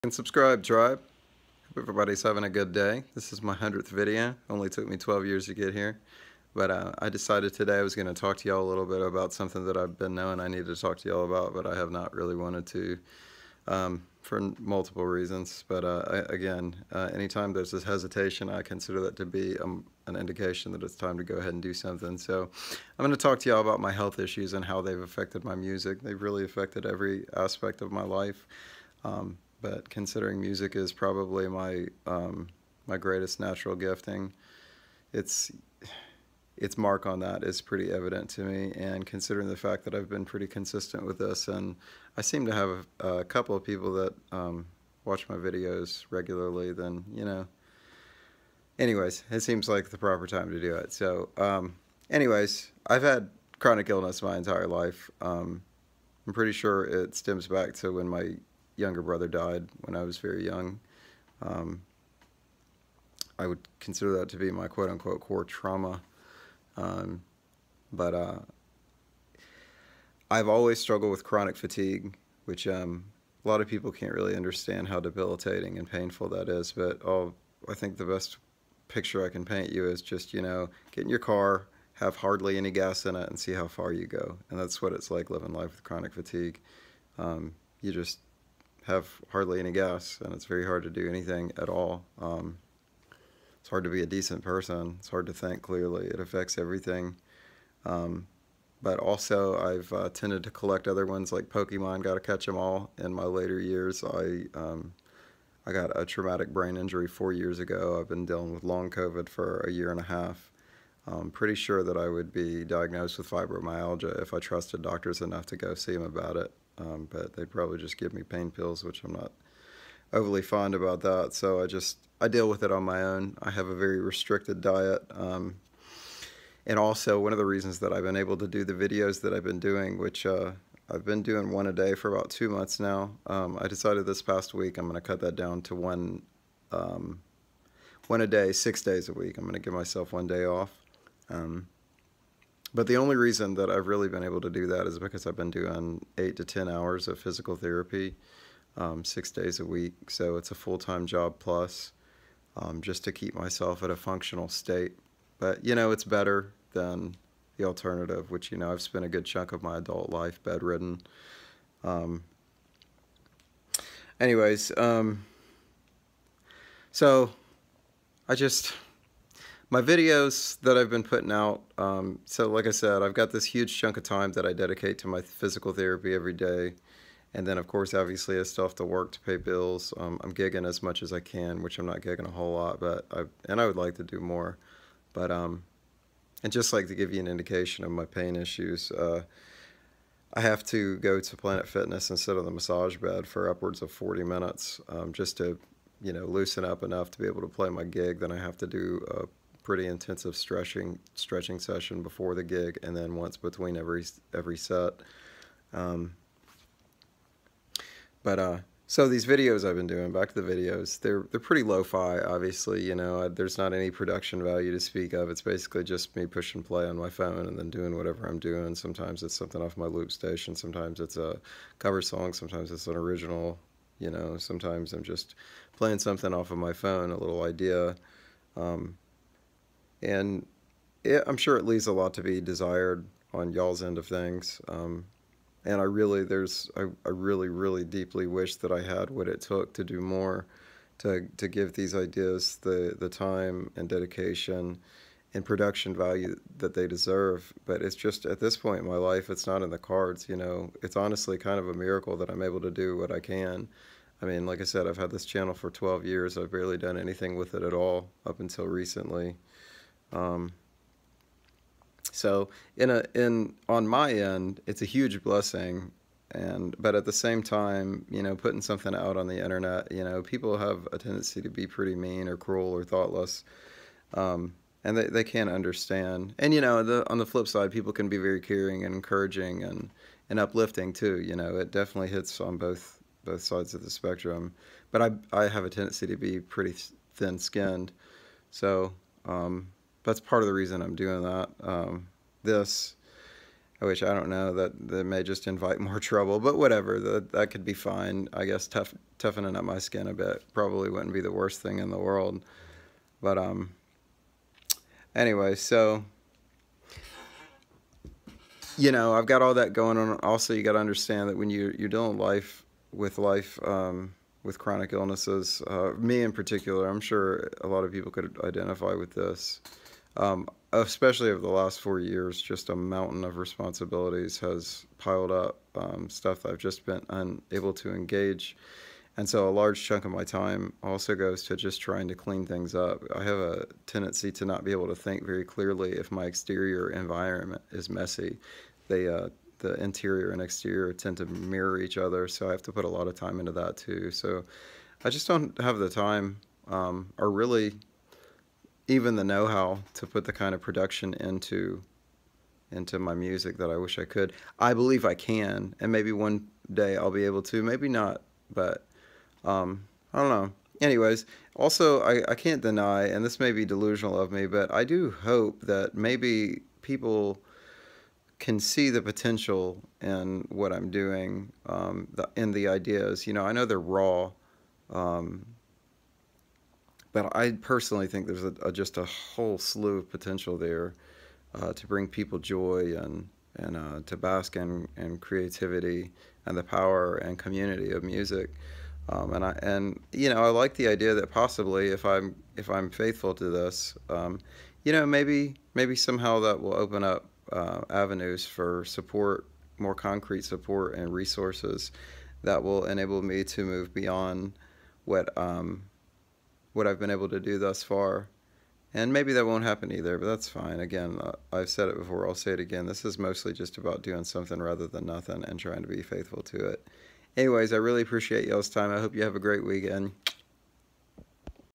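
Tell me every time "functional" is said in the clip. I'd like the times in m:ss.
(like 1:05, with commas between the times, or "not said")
2:33.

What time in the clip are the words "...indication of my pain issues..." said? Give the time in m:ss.
3:07.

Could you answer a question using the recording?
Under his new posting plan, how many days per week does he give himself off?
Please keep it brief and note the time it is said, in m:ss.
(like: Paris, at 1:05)
1, at 2:20.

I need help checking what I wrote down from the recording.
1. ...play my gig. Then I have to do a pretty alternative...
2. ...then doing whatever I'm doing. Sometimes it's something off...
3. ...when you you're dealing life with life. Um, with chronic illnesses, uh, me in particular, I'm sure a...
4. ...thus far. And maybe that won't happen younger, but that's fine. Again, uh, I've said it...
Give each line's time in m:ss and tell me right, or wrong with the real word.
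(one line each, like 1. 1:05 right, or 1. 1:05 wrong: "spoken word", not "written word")
1. 3:17 wrong: "intensive", not "alternative"
2. 3:37 right
3. 5:11 right
4. 6:47 wrong: "either", not "younger".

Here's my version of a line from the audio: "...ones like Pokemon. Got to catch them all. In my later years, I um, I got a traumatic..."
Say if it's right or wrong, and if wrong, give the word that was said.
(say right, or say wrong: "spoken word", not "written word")
right.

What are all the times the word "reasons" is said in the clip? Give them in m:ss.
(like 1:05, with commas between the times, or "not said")
0:15, 2:07, 2:23, 4:50.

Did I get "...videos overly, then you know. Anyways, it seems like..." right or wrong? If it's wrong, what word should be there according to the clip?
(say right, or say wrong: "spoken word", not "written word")
wrong: "regularly", not "overly".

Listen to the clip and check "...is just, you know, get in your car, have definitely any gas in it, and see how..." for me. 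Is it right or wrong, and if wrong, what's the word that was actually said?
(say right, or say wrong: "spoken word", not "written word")
wrong: "hardly", not "definitely".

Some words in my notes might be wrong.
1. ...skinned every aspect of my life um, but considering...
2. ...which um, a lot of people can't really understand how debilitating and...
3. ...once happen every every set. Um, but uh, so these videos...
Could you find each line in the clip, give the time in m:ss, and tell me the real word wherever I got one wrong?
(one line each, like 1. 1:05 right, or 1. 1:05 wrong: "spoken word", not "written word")
1. 0:26 wrong: "affected", not "skinned"
2. 1:12 right
3. 3:23 wrong: "between", not "happen".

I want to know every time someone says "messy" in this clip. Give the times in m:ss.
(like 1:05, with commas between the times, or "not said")
5:37.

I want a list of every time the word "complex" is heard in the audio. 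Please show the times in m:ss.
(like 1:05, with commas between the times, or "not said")
not said.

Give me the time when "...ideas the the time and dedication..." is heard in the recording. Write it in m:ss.
4:01.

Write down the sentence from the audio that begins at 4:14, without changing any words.
I mean, like I said, I've had this channel for 12 years.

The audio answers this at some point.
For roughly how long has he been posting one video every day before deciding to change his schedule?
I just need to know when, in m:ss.
2:12.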